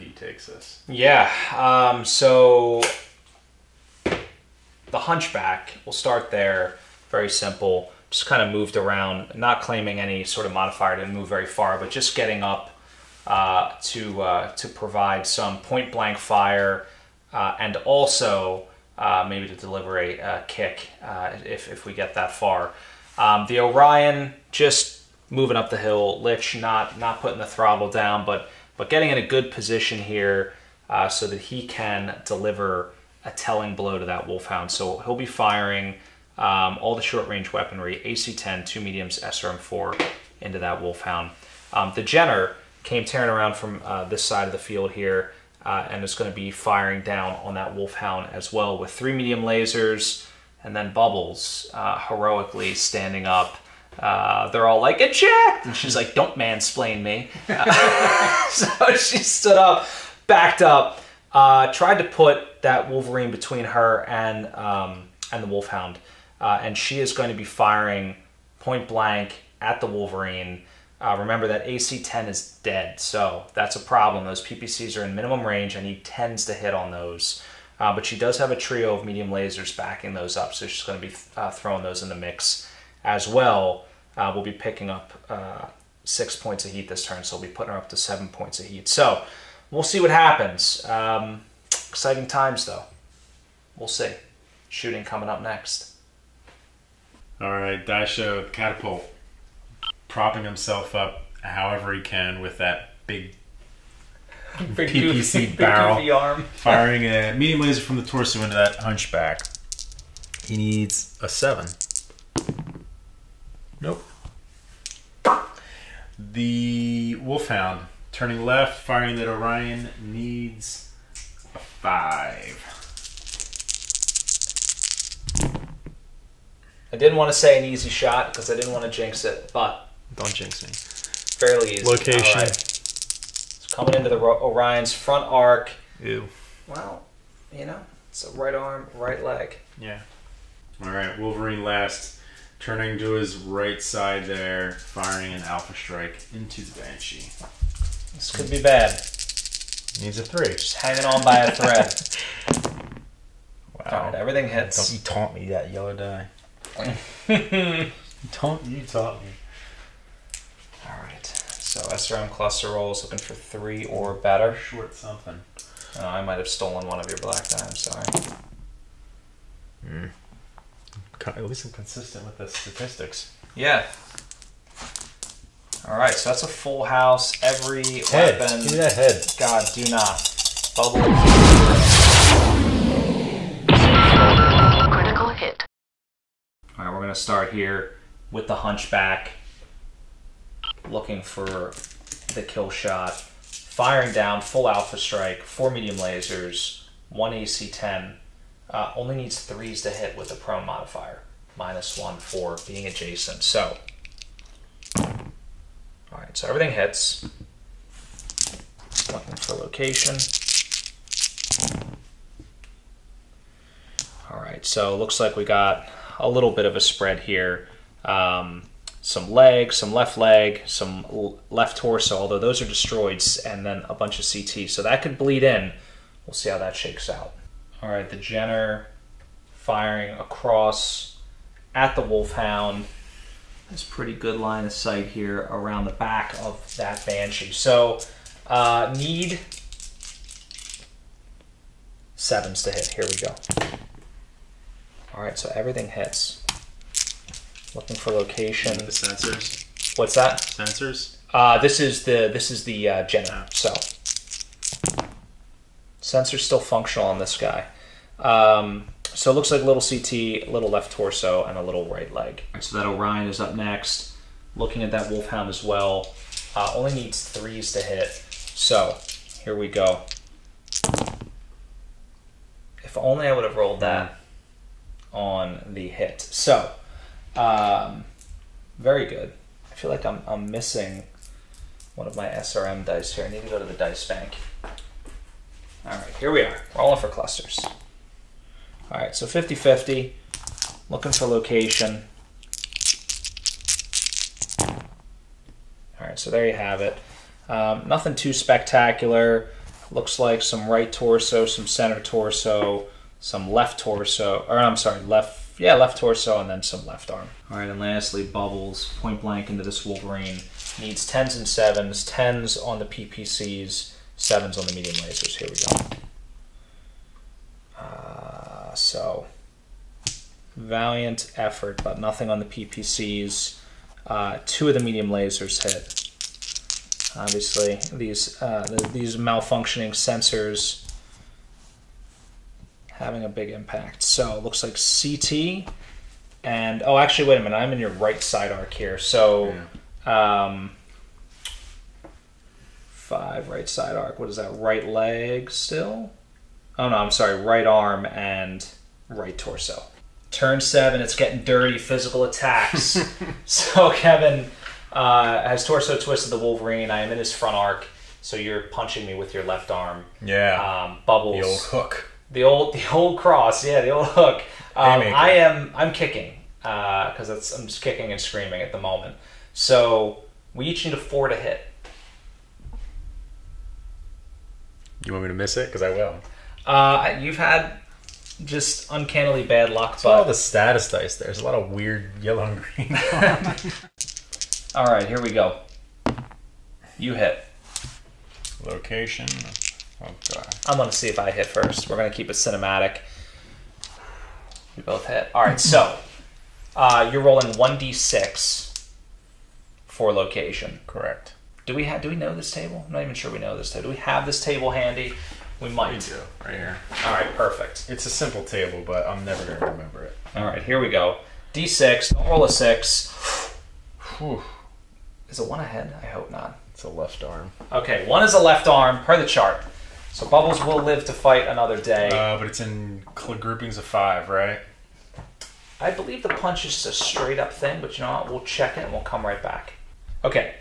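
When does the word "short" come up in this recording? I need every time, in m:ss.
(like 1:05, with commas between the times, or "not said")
0:37, 2:44.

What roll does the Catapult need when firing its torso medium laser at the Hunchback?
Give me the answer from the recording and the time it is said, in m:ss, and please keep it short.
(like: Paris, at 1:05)
7, at 1:50.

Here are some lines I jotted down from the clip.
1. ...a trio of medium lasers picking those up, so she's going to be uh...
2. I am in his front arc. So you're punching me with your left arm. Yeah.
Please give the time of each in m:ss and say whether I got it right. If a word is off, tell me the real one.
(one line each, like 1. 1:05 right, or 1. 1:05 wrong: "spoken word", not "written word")
1. 1:18 wrong: "backing", not "picking"
2. 5:56 right.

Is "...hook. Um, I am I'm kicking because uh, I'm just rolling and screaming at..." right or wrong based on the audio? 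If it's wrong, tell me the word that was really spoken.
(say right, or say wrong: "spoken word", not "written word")
wrong: "kicking", not "rolling".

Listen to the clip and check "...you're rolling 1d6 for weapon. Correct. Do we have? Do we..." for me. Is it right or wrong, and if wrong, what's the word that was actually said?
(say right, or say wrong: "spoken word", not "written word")
wrong: "location", not "weapon".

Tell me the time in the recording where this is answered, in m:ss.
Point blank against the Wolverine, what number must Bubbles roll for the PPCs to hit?
5:12.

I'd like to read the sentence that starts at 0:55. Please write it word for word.
And she's like, don't mansplain me.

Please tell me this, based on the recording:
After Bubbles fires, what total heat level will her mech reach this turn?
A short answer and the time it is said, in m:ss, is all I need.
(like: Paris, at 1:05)
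7, at 1:27.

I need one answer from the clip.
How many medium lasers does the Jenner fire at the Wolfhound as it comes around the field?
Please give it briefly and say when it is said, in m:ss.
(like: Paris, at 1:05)
3, at 0:48.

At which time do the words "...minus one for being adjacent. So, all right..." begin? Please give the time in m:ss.
3:21.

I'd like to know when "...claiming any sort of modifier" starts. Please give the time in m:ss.
0:09.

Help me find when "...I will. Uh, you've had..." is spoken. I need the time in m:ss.
6:15.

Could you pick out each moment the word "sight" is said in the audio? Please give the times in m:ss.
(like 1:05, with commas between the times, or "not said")
3:54.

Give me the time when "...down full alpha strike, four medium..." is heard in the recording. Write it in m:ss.
3:14.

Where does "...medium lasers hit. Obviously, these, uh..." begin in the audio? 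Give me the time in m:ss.
5:24.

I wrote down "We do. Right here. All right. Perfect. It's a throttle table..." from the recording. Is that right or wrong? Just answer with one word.
wrong.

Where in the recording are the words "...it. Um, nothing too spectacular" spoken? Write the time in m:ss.
4:56.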